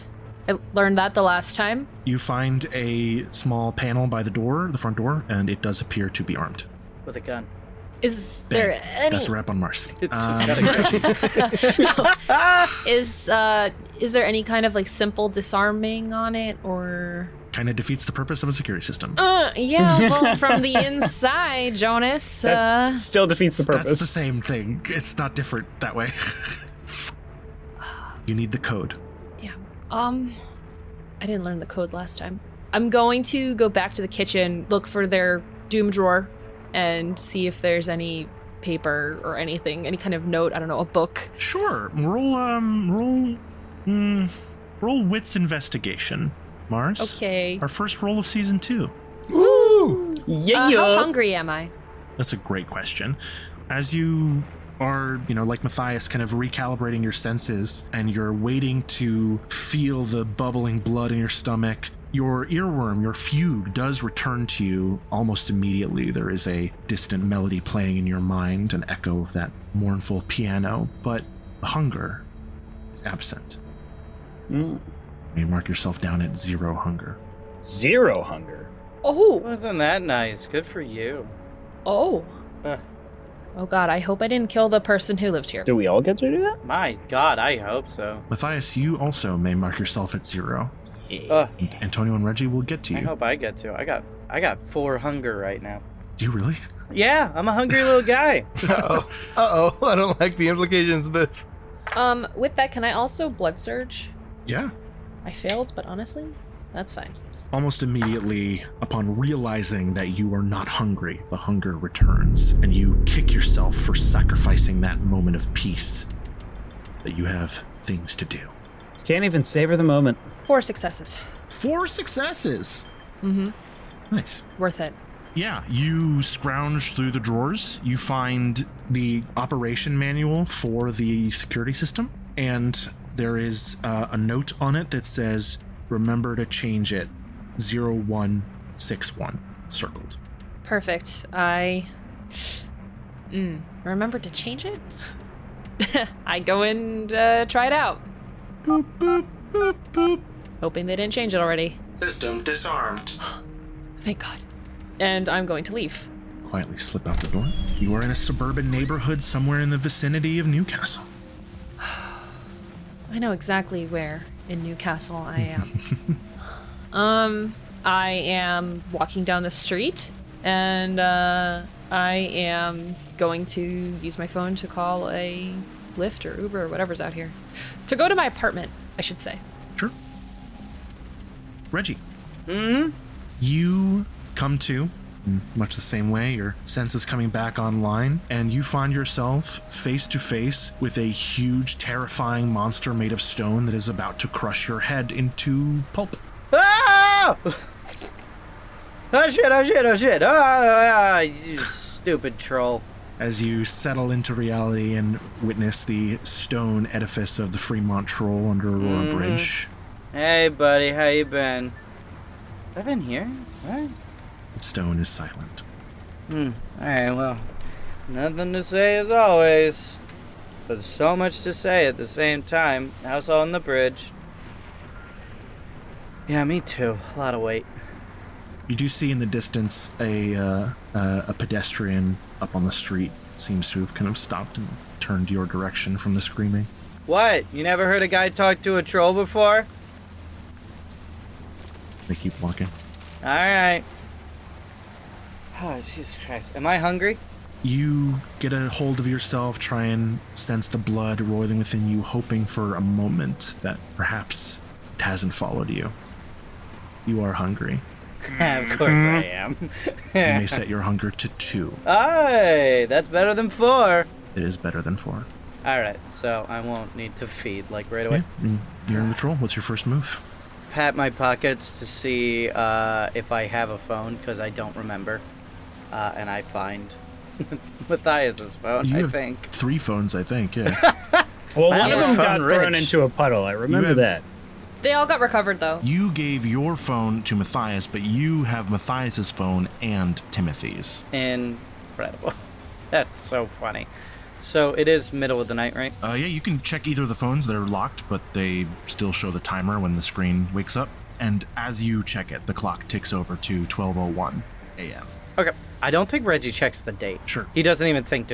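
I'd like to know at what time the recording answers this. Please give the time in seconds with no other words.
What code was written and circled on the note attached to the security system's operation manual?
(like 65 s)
137 s.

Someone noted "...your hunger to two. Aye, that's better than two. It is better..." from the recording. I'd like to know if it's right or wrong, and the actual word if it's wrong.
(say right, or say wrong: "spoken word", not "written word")
wrong: "four", not "two".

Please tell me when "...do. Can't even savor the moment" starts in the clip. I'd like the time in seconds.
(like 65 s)
118 s.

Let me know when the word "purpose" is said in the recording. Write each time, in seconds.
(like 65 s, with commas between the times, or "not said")
18 s, 23 s.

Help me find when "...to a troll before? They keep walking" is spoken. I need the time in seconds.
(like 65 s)
238 s.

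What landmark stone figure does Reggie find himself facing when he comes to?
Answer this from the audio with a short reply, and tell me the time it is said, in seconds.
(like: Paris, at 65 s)
Fremont Troll, at 207 s.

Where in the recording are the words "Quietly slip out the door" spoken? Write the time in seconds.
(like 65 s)
156 s.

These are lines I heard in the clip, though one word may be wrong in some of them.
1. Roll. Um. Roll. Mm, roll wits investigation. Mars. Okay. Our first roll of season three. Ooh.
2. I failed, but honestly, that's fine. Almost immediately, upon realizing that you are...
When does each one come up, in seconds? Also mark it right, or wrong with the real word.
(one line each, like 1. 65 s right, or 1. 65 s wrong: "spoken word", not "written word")
1. 41 s wrong: "two", not "three"
2. 105 s right.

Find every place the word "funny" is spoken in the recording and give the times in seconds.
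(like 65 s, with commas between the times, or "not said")
293 s.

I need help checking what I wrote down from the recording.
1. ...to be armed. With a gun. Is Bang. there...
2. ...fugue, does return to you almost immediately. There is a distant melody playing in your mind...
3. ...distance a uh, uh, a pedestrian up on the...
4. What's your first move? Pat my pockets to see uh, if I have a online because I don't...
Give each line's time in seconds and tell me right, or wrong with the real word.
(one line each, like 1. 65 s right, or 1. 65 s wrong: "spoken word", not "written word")
1. 6 s right
2. 63 s right
3. 229 s right
4. 269 s wrong: "phone", not "online".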